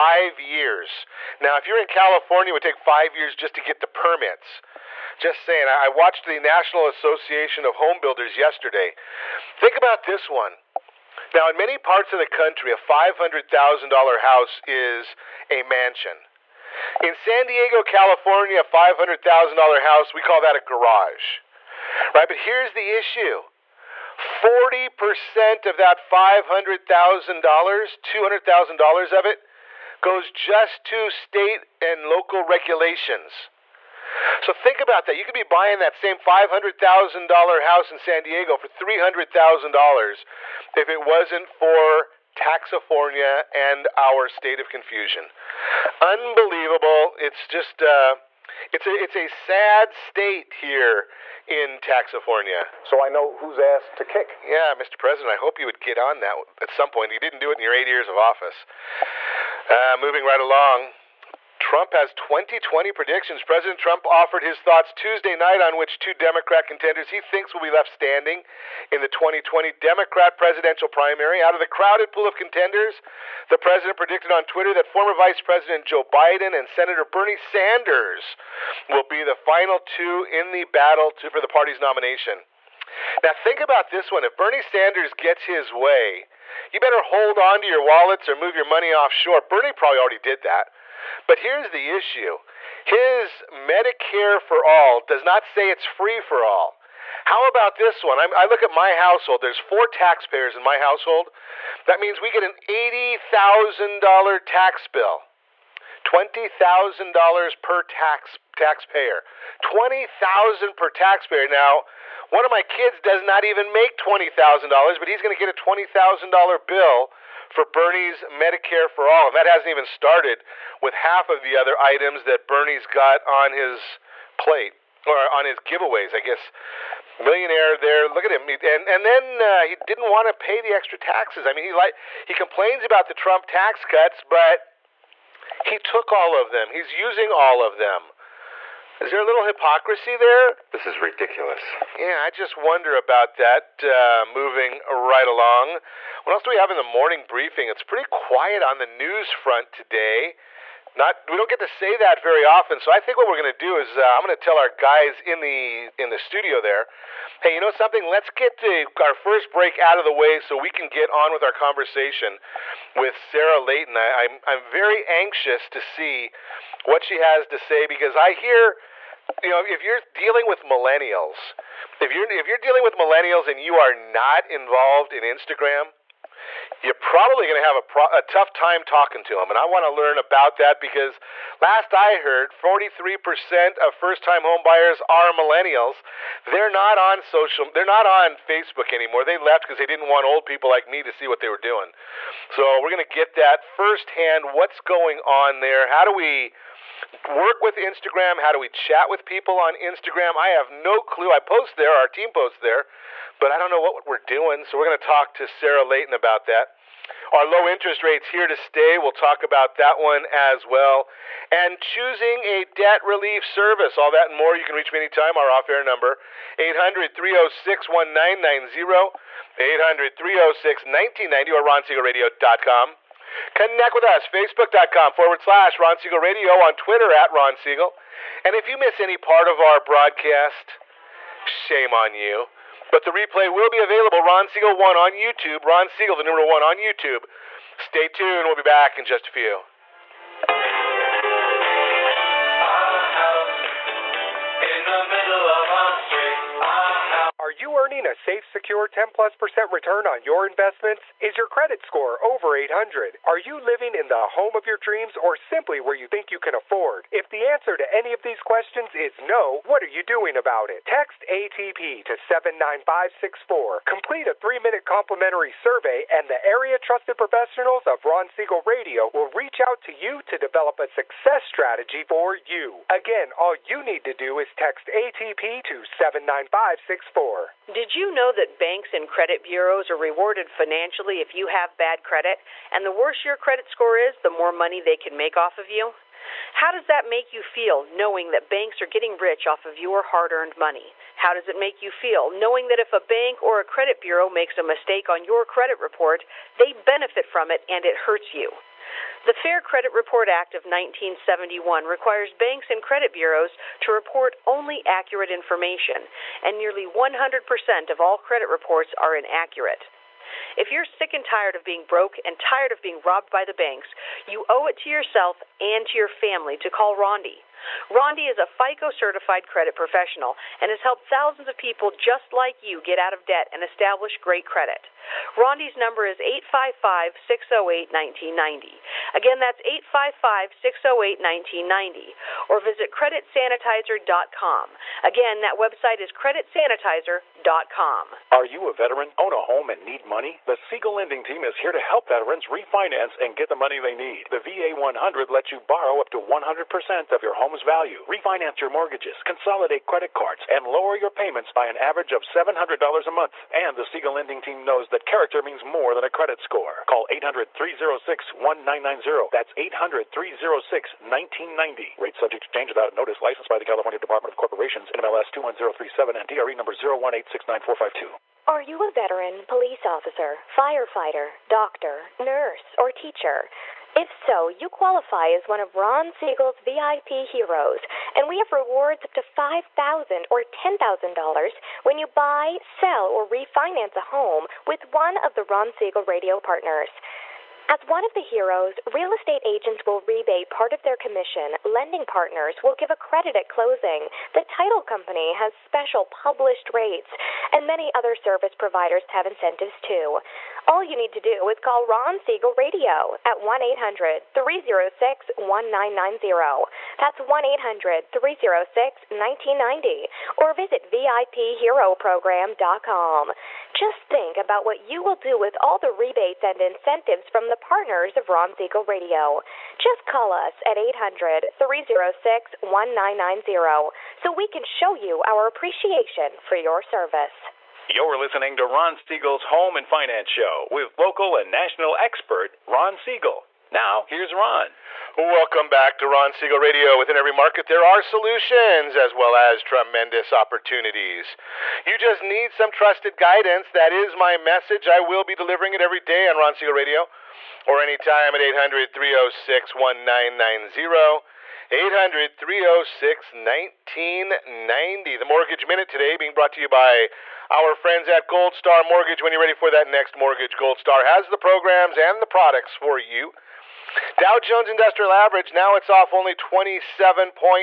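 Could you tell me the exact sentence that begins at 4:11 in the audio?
Is your credit score over 800?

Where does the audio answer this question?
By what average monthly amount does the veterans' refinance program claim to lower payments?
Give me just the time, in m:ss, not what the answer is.
5:52.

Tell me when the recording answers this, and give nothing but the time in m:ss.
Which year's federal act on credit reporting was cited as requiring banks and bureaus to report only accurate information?
5:00.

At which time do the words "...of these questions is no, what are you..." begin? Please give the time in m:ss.
4:18.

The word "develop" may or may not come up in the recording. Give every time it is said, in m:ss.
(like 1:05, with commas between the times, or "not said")
4:30.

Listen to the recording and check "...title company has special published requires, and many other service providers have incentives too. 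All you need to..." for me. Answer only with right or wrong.
wrong.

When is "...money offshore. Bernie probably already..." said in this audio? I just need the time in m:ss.
1:28.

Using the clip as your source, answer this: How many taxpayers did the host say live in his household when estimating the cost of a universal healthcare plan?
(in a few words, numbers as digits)
4.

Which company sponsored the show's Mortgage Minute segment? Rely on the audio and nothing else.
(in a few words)
Gold Star Mortgage.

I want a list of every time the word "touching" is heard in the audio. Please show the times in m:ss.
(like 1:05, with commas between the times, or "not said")
not said.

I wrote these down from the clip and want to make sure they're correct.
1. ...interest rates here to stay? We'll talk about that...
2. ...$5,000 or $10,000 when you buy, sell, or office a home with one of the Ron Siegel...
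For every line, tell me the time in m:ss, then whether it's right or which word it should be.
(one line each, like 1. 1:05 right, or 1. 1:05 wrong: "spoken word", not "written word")
1. 3:27 right
2. 6:19 wrong: "refinance", not "office".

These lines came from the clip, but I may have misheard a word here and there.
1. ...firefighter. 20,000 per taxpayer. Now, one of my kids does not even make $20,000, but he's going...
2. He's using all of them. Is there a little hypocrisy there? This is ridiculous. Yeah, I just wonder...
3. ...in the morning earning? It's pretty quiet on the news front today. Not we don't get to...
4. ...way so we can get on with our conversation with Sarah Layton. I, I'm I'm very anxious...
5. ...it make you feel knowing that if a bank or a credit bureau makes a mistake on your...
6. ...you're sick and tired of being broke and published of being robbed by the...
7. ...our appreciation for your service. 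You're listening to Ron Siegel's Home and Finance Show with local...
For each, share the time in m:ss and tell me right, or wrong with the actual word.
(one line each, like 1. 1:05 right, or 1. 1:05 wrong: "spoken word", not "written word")
1. 1:48 wrong: "taxpayer", not "firefighter"
2. 2:16 right
3. 2:26 wrong: "briefing", not "earning"
4. 2:40 right
5. 4:51 right
6. 5:10 wrong: "tired", not "published"
7. 7:05 right.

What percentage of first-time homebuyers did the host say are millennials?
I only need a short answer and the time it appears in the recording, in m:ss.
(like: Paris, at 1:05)
43%, at 3:02.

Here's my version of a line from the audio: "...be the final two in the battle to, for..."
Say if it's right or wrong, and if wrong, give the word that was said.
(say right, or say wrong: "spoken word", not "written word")
right.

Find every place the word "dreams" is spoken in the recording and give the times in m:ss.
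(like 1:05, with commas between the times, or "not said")
4:14.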